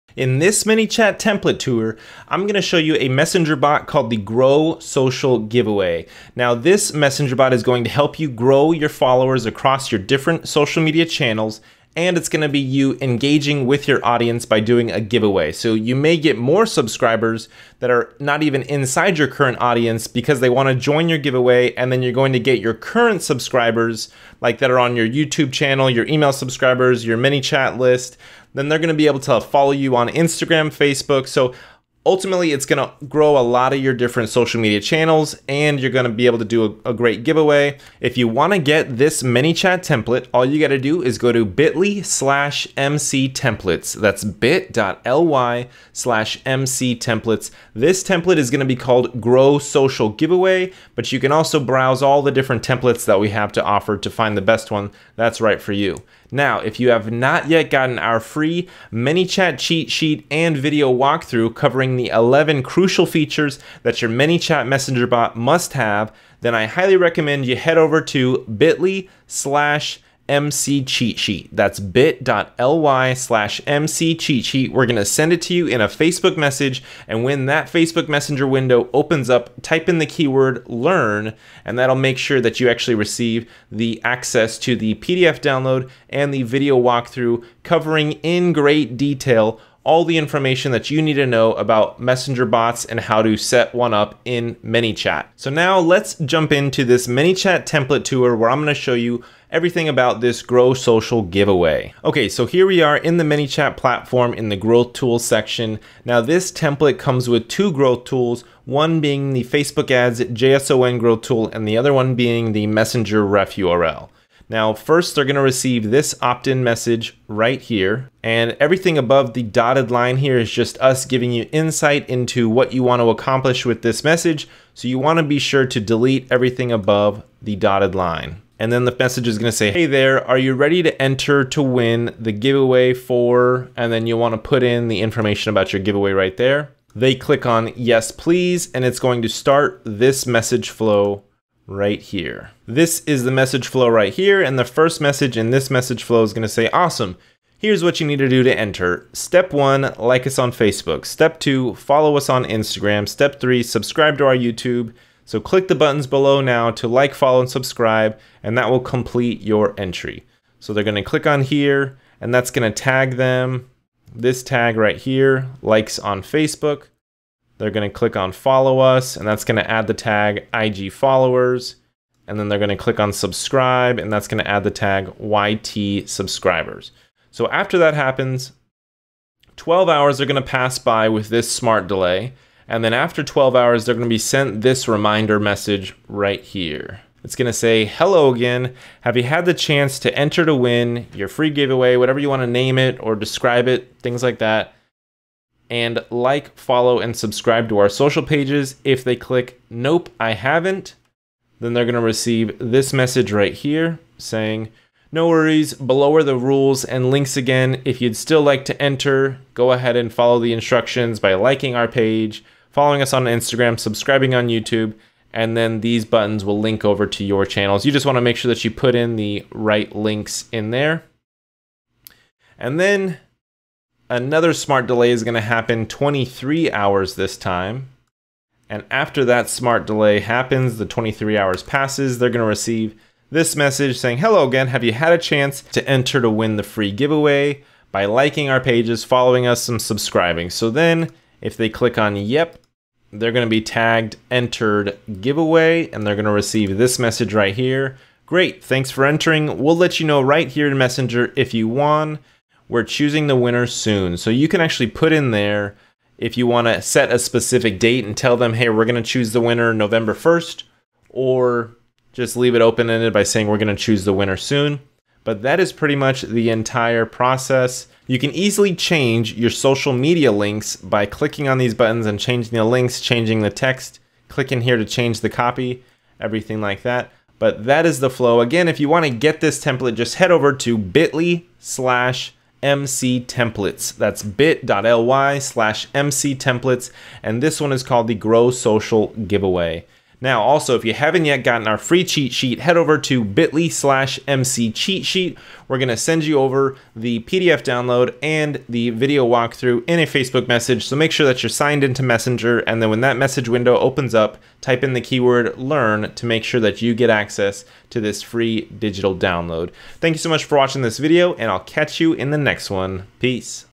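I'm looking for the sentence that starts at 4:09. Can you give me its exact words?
We'll let you know right here in Messenger if you won.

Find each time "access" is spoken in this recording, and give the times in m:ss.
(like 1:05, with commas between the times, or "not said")
1:24, 5:07.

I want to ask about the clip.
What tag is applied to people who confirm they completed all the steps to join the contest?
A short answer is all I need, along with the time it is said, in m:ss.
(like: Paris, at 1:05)
entered giveaway, at 4:04.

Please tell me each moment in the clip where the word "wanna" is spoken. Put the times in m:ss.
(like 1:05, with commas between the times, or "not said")
0:20, 3:12.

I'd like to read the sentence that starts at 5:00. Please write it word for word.
So make sure that you're signed into Messenger.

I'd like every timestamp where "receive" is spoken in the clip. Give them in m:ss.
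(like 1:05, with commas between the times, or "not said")
1:22, 1:55, 3:21, 3:52, 4:06.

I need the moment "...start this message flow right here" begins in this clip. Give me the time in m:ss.
2:19.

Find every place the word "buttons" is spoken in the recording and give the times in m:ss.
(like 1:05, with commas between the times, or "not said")
2:35, 3:36, 4:31.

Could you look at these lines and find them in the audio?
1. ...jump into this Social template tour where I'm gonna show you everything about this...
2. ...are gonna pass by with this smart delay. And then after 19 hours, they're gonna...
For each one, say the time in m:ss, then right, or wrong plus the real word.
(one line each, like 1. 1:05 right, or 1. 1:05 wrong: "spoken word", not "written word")
1. 1:36 wrong: "ManyChat", not "Social"
2. 3:00 wrong: "12", not "19".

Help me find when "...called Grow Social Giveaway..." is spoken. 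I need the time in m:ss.
0:48.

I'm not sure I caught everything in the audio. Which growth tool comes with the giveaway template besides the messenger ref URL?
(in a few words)
Facebook ads JSON.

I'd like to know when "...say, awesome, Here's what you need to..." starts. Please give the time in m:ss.
2:26.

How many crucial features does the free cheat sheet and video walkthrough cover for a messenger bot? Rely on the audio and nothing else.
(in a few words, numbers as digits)
11.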